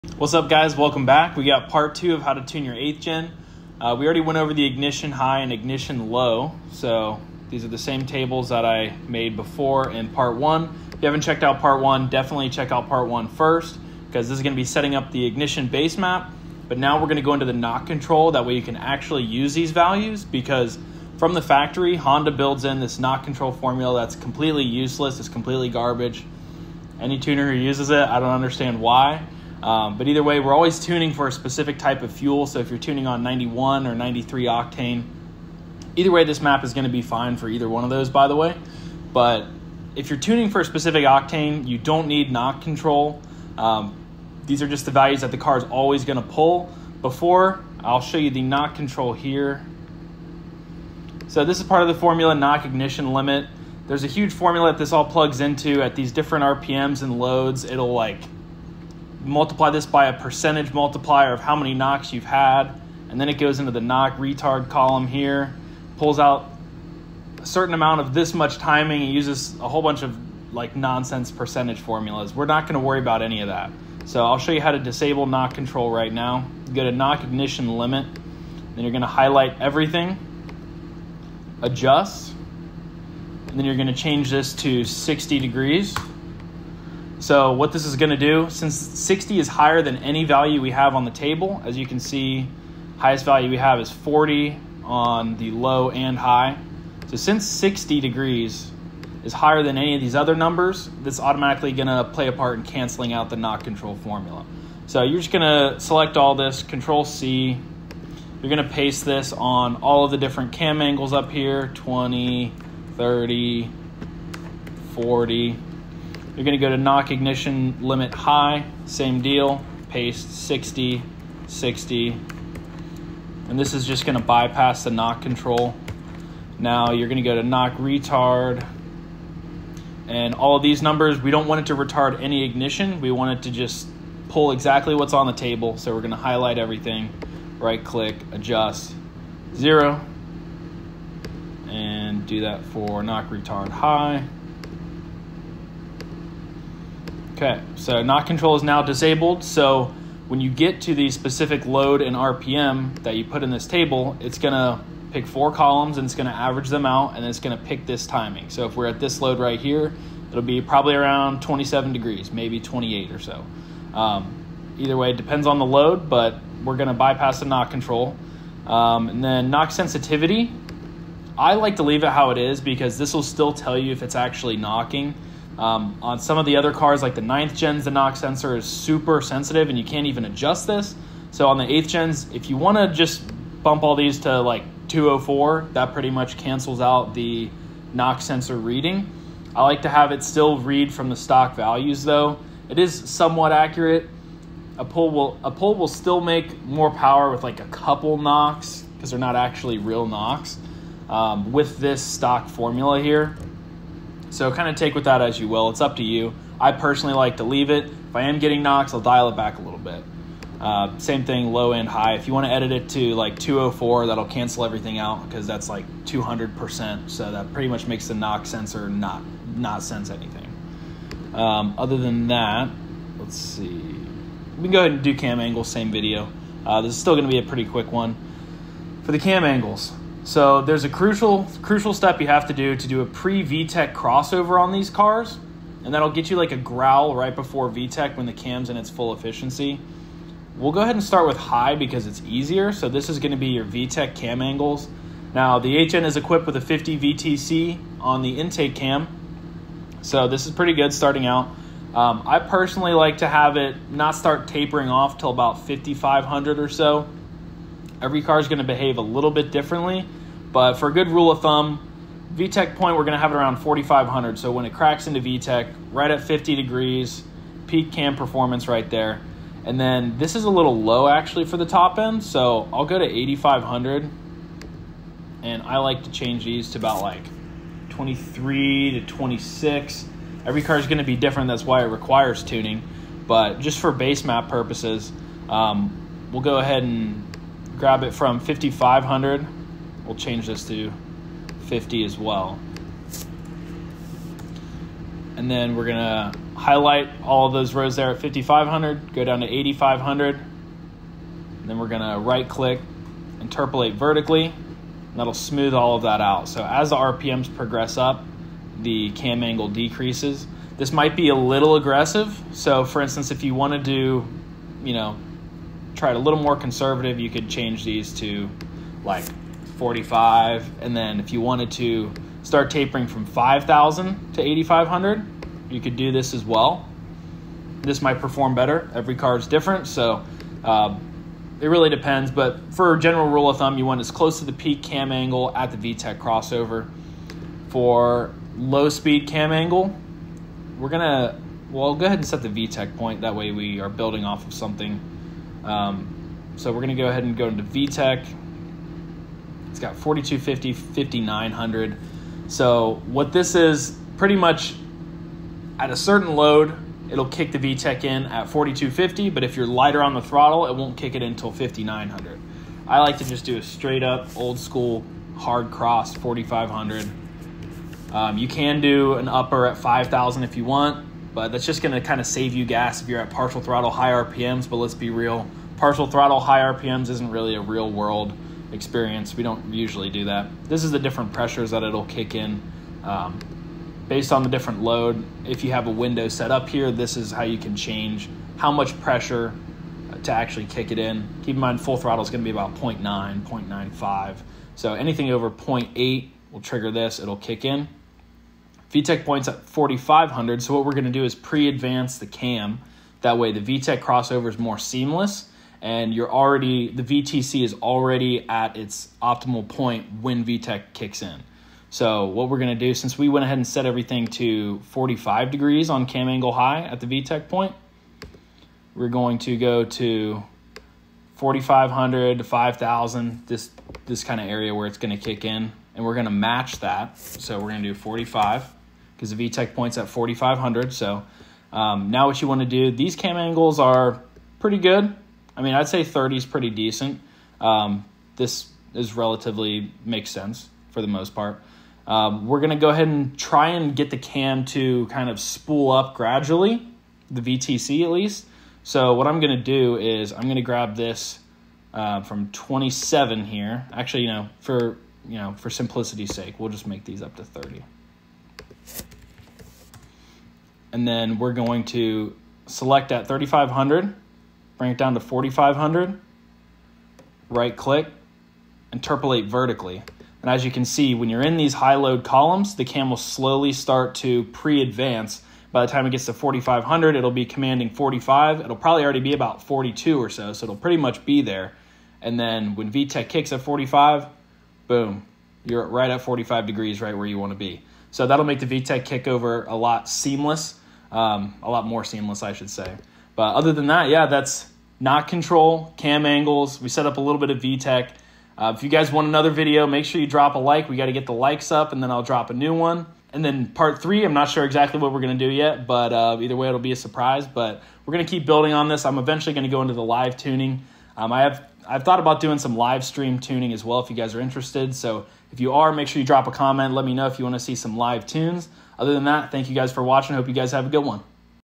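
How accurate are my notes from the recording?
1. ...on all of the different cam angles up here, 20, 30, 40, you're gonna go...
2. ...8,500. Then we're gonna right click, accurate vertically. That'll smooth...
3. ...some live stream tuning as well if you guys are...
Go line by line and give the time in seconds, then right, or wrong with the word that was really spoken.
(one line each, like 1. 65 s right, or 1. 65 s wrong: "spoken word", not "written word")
1. 109 s right
2. 299 s wrong: "interpolate", not "accurate"
3. 512 s right.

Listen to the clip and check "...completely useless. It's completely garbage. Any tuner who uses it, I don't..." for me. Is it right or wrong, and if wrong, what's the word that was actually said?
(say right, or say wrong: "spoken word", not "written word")
right.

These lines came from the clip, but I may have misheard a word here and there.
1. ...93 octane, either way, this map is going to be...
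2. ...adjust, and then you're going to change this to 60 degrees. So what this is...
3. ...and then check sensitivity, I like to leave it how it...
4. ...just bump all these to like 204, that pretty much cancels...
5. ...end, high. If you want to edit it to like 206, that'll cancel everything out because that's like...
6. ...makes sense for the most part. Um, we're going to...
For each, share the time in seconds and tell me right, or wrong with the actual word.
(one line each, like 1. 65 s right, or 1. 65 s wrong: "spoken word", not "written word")
1. 33 s right
2. 81 s right
3. 169 s wrong: "knock", not "check"
4. 182 s right
5. 211 s wrong: "204", not "206"
6. 440 s right.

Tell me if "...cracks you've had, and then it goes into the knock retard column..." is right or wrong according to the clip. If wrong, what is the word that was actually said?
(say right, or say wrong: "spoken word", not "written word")
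wrong: "knocks", not "cracks".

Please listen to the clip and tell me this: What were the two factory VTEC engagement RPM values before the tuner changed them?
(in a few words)
4250 and 5900.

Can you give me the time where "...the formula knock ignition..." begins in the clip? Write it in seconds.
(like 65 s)
51 s.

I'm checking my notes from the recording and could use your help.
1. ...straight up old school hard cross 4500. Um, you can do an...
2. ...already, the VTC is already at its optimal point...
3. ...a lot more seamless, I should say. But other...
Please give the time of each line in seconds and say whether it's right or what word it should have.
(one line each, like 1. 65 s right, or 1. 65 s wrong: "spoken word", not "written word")
1. 363 s right
2. 406 s right
3. 491 s right.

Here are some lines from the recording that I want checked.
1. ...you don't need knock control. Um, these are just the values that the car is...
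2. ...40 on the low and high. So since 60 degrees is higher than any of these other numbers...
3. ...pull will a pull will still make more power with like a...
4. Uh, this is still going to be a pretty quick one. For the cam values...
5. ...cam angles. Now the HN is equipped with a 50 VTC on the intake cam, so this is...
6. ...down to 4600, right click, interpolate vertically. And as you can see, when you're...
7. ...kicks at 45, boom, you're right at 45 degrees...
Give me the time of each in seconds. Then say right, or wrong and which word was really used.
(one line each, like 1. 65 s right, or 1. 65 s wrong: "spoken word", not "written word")
1. 41 s right
2. 93 s right
3. 194 s right
4. 226 s wrong: "angles", not "values"
5. 244 s right
6. 464 s wrong: "4500", not "4600"
7. 483 s right.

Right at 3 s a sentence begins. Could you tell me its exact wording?
Uh, we already went over the ignition high and ignition low.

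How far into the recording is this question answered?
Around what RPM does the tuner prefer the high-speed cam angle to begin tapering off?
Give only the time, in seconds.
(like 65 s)
255 s.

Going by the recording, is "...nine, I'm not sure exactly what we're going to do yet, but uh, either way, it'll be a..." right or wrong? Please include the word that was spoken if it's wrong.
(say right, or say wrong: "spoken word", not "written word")
wrong: "three", not "nine".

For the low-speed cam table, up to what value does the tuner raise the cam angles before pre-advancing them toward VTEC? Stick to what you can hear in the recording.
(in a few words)
30.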